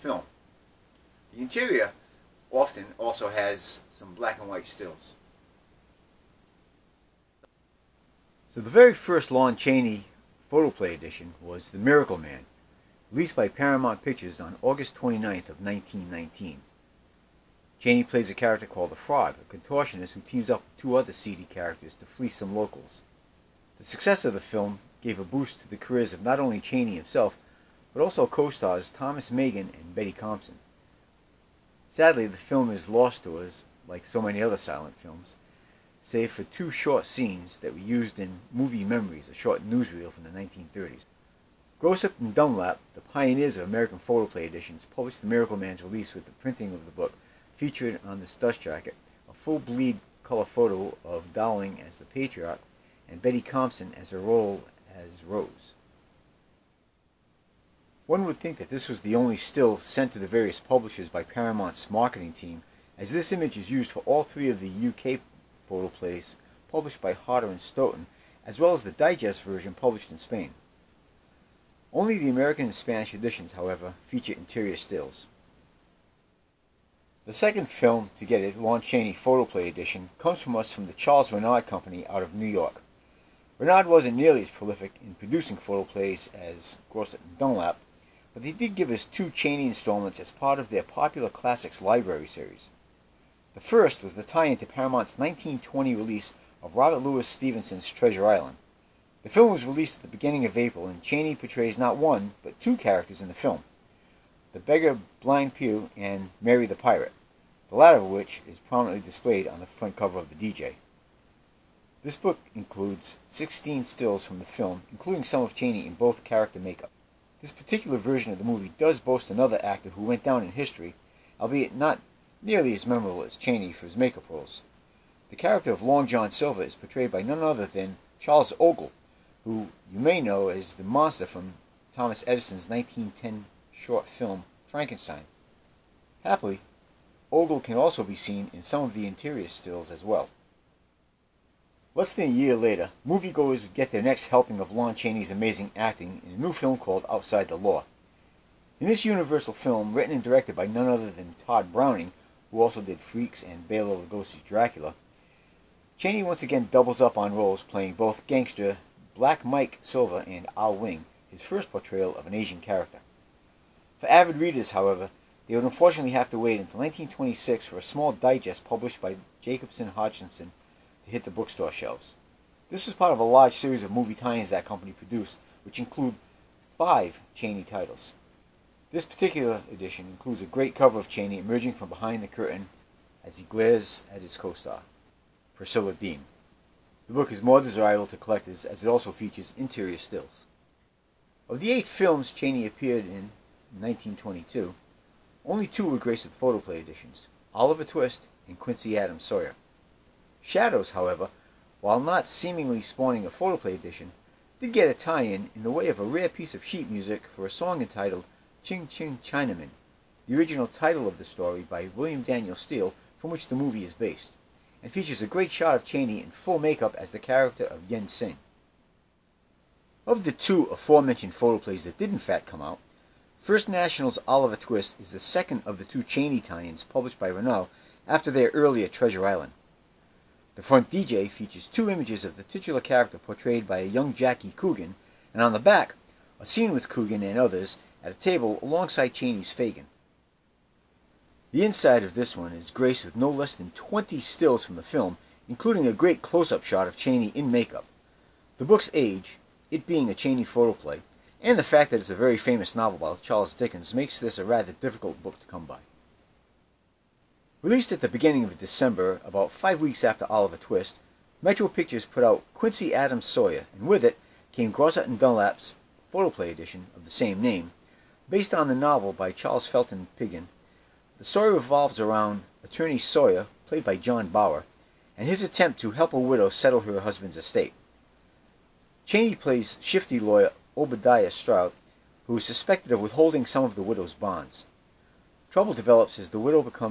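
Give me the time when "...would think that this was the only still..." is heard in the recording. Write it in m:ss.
0:58.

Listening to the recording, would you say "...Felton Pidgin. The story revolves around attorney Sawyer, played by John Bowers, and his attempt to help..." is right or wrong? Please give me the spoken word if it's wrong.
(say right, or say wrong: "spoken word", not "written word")
right.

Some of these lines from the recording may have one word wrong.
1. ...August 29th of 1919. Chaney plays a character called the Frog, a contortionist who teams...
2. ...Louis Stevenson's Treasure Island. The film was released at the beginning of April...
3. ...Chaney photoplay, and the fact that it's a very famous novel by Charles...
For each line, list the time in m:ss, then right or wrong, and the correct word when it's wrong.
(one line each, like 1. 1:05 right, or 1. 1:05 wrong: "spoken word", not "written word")
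1. 0:14 right
2. 1:37 right
3. 4:10 right.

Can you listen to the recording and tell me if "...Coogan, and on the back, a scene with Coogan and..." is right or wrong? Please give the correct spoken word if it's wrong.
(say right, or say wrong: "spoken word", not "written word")
right.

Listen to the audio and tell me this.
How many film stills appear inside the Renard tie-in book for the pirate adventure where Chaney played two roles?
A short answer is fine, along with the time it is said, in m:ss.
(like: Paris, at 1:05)
16, at 1:53.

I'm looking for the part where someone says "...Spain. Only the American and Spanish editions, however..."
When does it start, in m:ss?
1:10.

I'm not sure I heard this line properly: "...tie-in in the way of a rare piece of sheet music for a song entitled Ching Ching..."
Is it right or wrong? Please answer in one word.
right.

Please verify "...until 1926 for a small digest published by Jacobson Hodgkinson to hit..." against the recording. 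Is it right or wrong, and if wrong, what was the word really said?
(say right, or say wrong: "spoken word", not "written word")
right.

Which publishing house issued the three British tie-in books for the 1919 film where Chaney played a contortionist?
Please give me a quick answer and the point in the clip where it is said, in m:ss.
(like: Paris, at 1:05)
Hodder and Stoughton, at 1:07.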